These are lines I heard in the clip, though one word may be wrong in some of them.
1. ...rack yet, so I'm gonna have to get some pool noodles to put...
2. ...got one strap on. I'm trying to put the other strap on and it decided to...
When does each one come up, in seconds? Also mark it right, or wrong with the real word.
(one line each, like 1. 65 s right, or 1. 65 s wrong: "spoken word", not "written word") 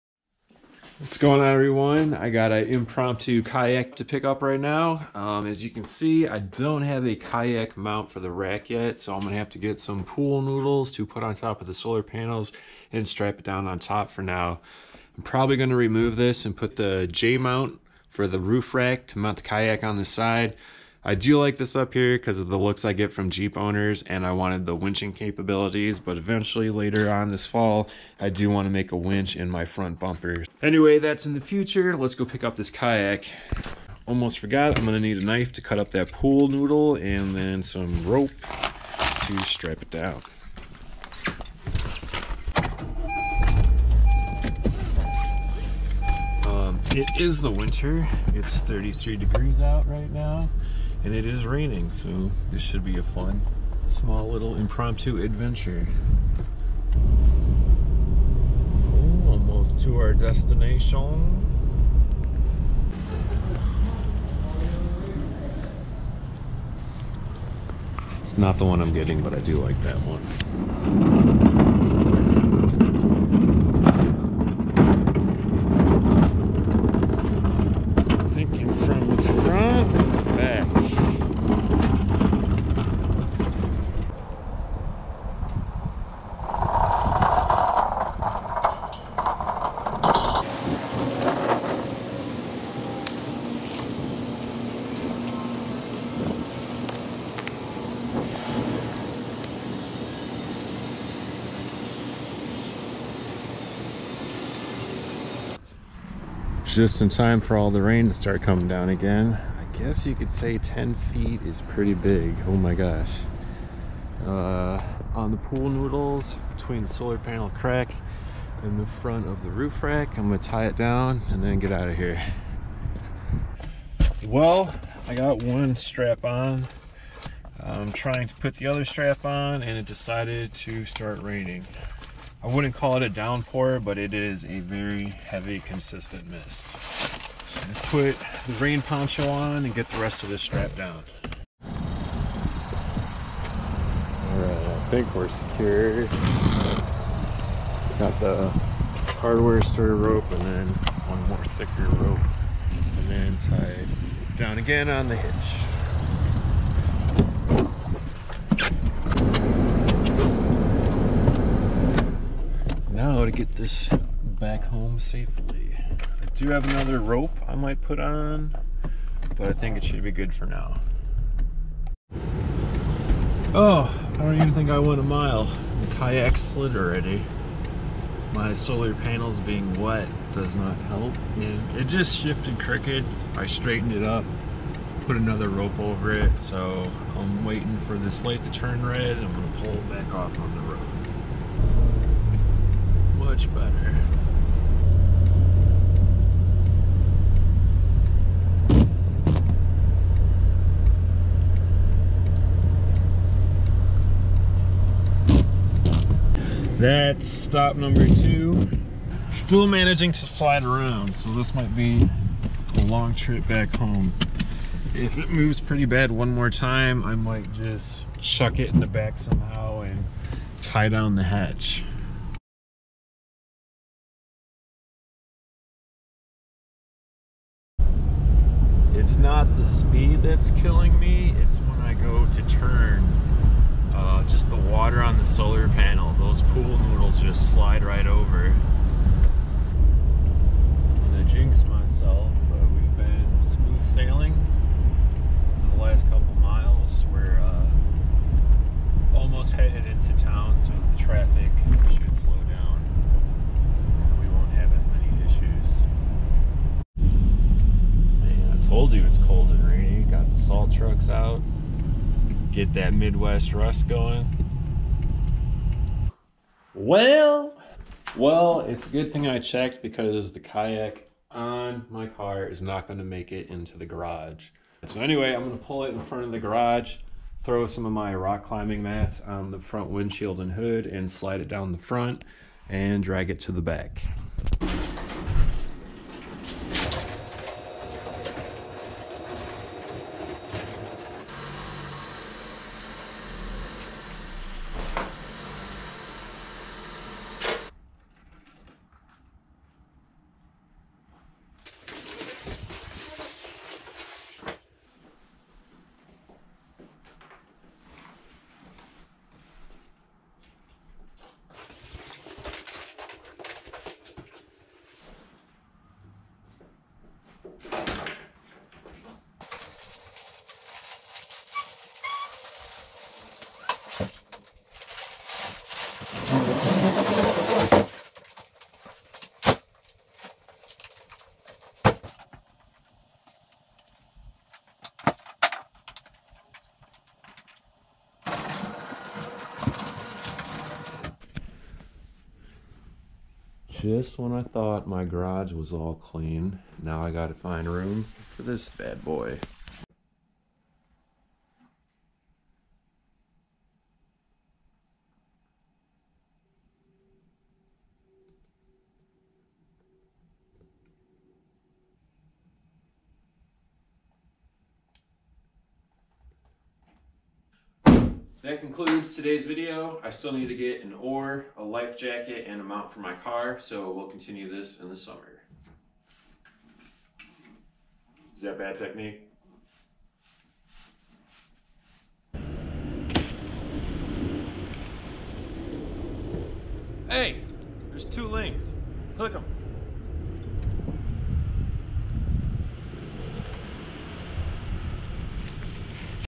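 1. 8 s right
2. 125 s right.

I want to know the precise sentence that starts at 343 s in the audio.
Just when I thought my garage was all clean, now I gotta find room for this bad boy.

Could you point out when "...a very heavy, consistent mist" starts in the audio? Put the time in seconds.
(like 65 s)
134 s.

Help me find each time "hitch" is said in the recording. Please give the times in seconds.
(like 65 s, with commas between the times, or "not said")
155 s.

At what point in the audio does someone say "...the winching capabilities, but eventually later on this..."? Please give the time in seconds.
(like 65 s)
24 s.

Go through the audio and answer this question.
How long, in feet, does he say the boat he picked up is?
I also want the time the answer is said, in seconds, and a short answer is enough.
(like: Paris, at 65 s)
10 feet, at 110 s.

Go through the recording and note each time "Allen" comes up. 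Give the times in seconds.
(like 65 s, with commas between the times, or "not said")
not said.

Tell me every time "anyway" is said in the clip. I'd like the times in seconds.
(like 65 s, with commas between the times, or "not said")
30 s, 275 s.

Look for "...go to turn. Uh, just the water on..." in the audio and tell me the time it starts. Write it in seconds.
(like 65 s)
231 s.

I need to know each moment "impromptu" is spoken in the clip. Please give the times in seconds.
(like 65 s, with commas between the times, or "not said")
2 s, 54 s.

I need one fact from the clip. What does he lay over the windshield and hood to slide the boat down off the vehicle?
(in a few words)
rock climbing mats.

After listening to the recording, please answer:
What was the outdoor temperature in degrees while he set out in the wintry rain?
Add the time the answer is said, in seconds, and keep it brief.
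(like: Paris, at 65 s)
33, at 48 s.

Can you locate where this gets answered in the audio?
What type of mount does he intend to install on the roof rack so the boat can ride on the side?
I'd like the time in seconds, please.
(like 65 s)
17 s.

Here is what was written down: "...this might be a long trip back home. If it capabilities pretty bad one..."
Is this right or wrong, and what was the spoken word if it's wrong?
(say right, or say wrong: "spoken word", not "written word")
wrong: "moves", not "capabilities".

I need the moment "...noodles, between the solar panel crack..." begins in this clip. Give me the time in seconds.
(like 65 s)
115 s.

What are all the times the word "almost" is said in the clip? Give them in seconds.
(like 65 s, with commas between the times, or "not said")
34 s, 59 s, 249 s.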